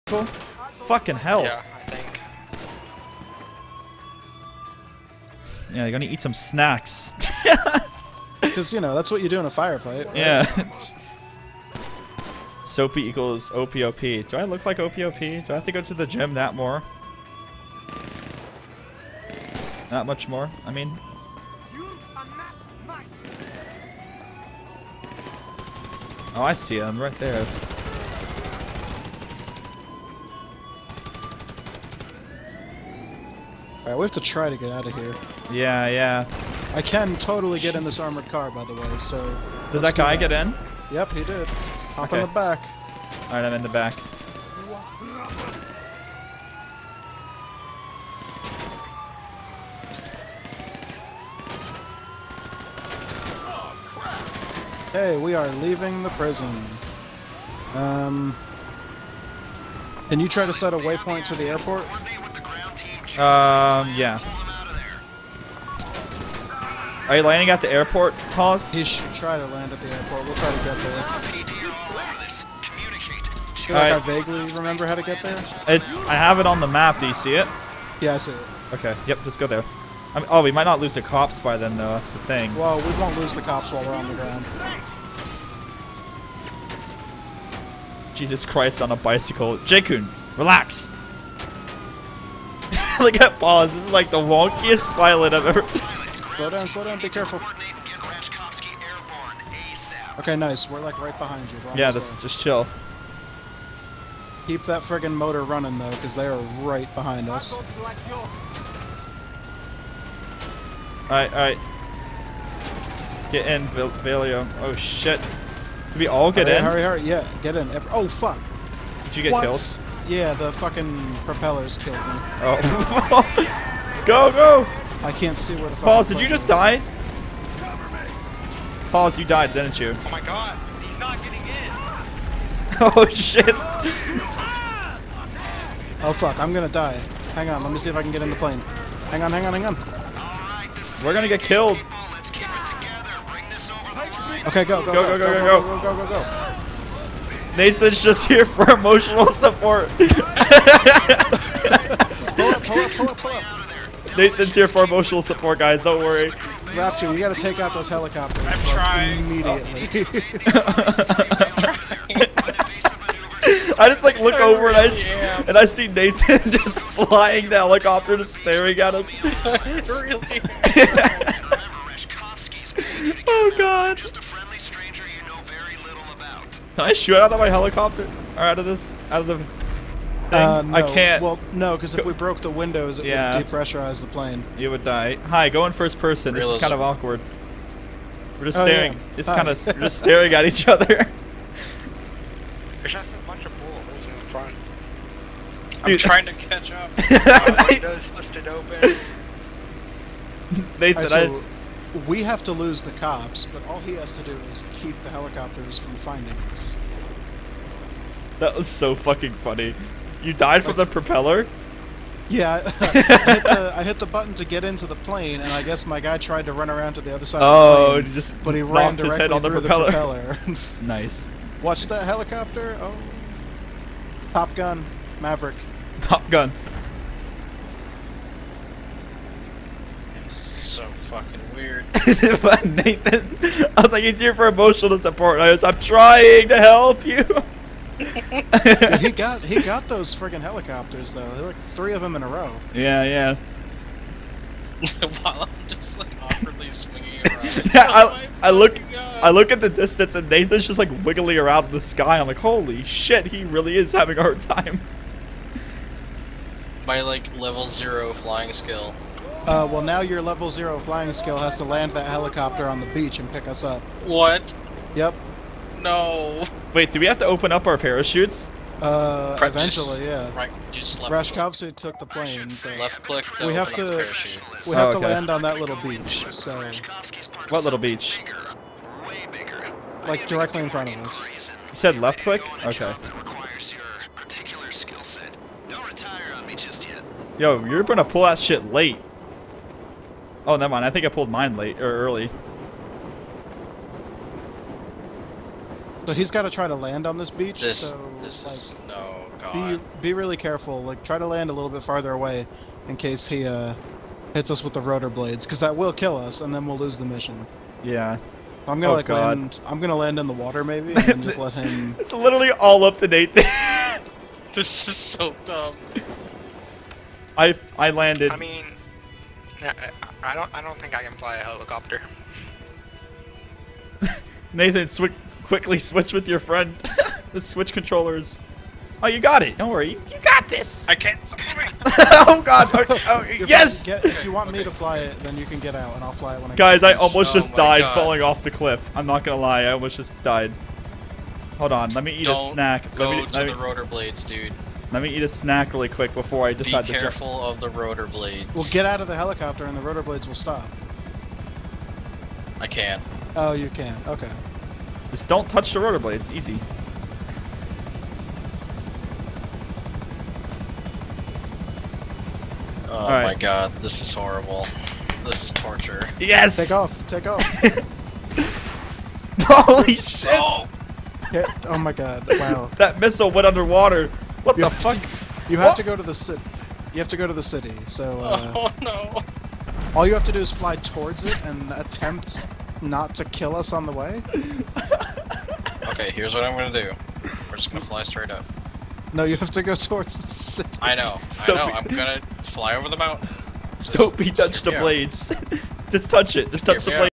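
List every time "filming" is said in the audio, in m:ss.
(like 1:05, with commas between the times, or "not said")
not said.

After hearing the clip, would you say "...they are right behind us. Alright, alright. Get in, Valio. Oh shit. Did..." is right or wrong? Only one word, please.
right.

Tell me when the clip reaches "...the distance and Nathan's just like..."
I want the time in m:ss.
4:09.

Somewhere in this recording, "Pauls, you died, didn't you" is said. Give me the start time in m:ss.
2:08.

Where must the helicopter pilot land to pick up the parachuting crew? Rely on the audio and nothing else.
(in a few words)
On the beach.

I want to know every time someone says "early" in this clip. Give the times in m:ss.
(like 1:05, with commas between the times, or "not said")
4:52.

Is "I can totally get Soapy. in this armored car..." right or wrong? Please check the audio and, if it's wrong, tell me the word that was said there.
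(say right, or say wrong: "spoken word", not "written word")
wrong: "Jesus", not "Soapy".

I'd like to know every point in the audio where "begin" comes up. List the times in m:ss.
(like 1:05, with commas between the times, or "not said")
not said.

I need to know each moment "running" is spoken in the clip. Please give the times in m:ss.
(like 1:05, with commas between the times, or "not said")
1:45.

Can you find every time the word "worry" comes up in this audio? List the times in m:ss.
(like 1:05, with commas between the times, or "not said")
2:35, 5:29.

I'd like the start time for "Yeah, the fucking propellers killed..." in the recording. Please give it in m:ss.
2:00.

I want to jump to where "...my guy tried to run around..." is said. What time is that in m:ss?
3:35.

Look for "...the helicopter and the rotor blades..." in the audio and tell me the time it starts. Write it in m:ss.
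5:49.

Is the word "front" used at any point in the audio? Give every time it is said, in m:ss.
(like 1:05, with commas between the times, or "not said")
3:14, 4:40.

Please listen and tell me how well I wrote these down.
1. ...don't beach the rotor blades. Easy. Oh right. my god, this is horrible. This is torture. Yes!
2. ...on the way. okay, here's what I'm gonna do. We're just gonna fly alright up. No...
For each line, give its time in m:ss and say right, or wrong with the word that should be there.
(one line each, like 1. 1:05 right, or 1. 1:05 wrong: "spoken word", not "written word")
1. 5:55 wrong: "touch", not "beach"
2. 6:23 wrong: "straight", not "alright".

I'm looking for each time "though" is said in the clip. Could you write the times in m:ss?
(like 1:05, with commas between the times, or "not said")
1:21, 1:45, 4:01.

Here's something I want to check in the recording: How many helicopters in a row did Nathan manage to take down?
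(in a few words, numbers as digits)
3.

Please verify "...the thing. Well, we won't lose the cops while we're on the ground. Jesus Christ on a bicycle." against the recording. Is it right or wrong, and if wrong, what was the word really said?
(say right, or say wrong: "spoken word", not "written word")
right.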